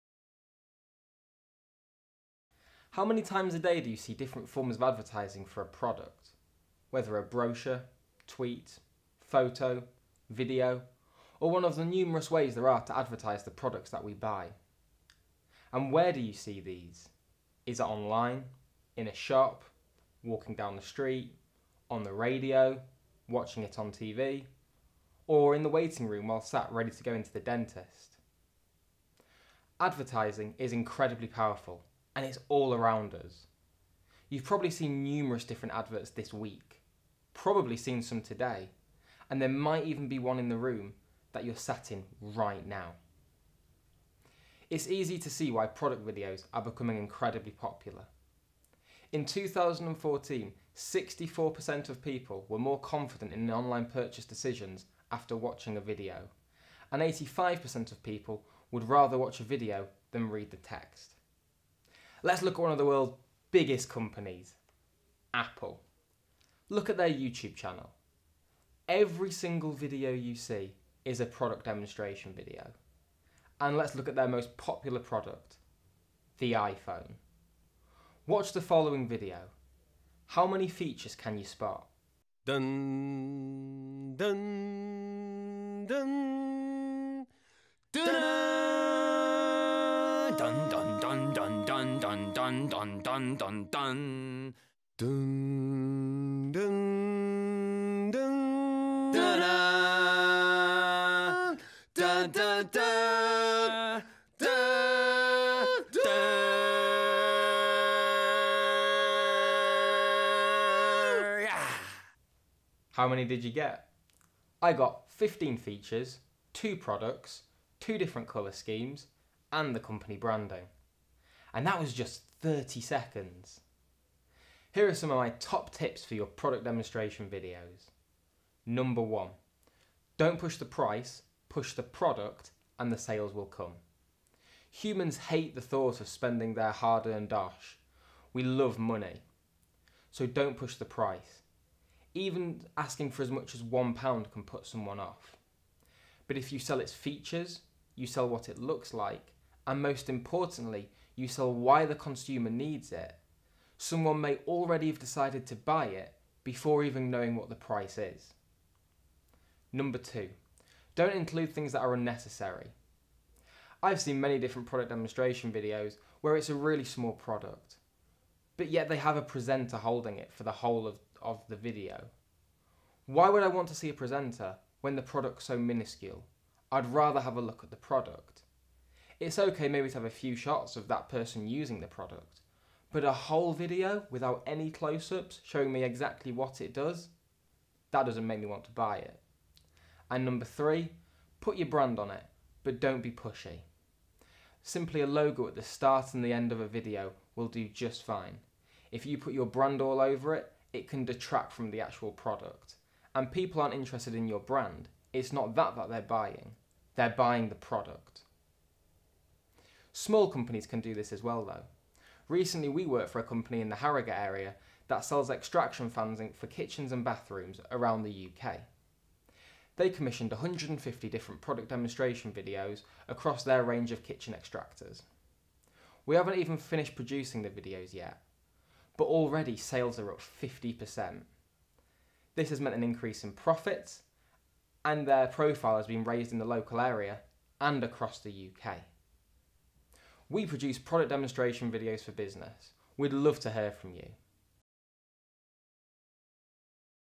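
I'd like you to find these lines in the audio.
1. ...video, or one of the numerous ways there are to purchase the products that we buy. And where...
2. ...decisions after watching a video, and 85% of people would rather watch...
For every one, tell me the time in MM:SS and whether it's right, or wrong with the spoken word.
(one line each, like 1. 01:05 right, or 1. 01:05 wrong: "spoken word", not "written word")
1. 00:10 wrong: "advertise", not "purchase"
2. 00:54 right.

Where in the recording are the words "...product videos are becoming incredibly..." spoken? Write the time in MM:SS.
00:45.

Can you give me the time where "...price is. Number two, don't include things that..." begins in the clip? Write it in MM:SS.
02:37.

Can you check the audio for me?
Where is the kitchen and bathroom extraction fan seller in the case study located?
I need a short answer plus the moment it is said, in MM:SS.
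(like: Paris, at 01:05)
Harrogate, at 03:33.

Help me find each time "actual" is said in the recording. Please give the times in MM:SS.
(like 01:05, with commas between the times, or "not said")
03:21.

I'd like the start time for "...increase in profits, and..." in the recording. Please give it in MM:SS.
03:52.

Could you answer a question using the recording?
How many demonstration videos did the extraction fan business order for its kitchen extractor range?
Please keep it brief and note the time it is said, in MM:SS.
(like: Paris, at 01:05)
150, at 03:40.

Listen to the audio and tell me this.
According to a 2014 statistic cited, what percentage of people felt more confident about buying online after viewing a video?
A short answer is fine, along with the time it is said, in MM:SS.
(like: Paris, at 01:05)
64%, at 00:50.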